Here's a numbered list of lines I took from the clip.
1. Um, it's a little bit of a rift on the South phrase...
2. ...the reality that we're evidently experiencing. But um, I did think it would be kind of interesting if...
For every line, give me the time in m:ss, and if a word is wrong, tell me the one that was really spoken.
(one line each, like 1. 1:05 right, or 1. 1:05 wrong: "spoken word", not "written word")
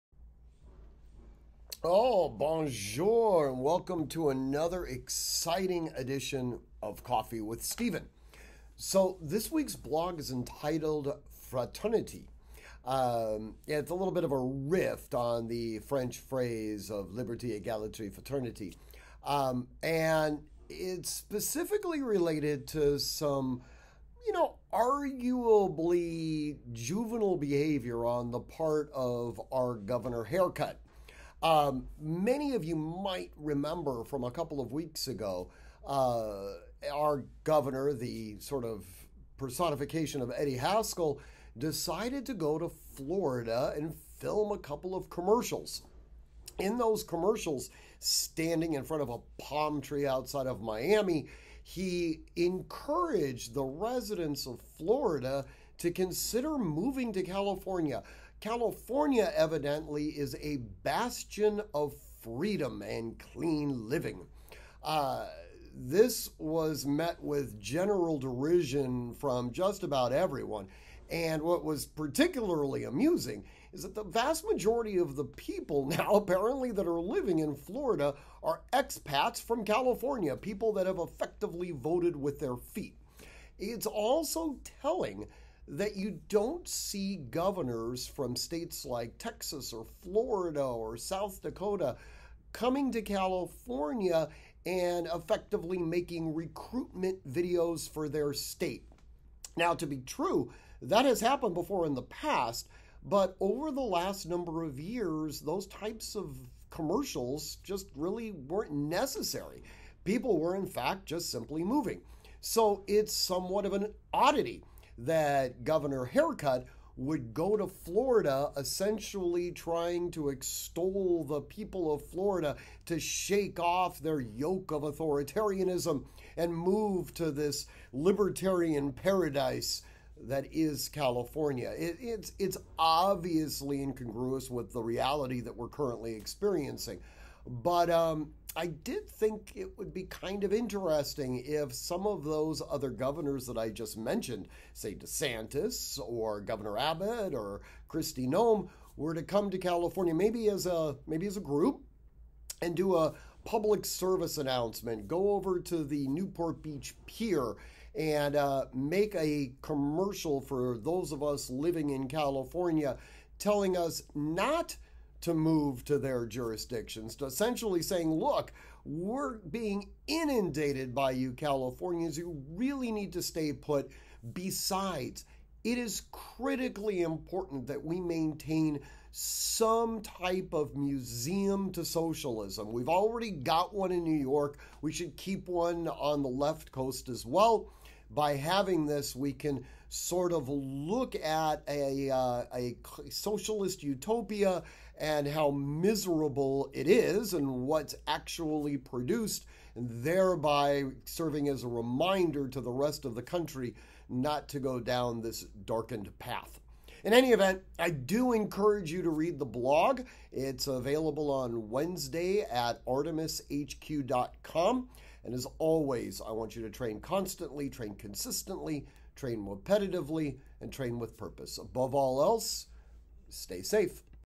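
1. 0:12 wrong: "French", not "South"
2. 2:14 wrong: "currently", not "evidently".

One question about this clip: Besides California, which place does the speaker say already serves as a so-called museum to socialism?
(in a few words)
New York.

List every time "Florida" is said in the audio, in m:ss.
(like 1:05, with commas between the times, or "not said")
0:42, 0:54, 1:17, 1:30, 1:57, 2:02.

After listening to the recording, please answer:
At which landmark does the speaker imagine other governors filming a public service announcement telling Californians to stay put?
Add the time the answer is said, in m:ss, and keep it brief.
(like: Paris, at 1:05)
Newport Beach Pier, at 2:36.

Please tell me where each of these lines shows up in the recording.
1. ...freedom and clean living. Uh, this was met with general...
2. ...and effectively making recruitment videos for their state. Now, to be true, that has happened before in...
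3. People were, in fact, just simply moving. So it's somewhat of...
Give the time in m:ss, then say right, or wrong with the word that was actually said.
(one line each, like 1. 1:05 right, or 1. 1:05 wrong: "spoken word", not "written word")
1. 1:02 right
2. 1:34 right
3. 1:50 right.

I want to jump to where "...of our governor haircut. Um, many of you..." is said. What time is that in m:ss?
0:28.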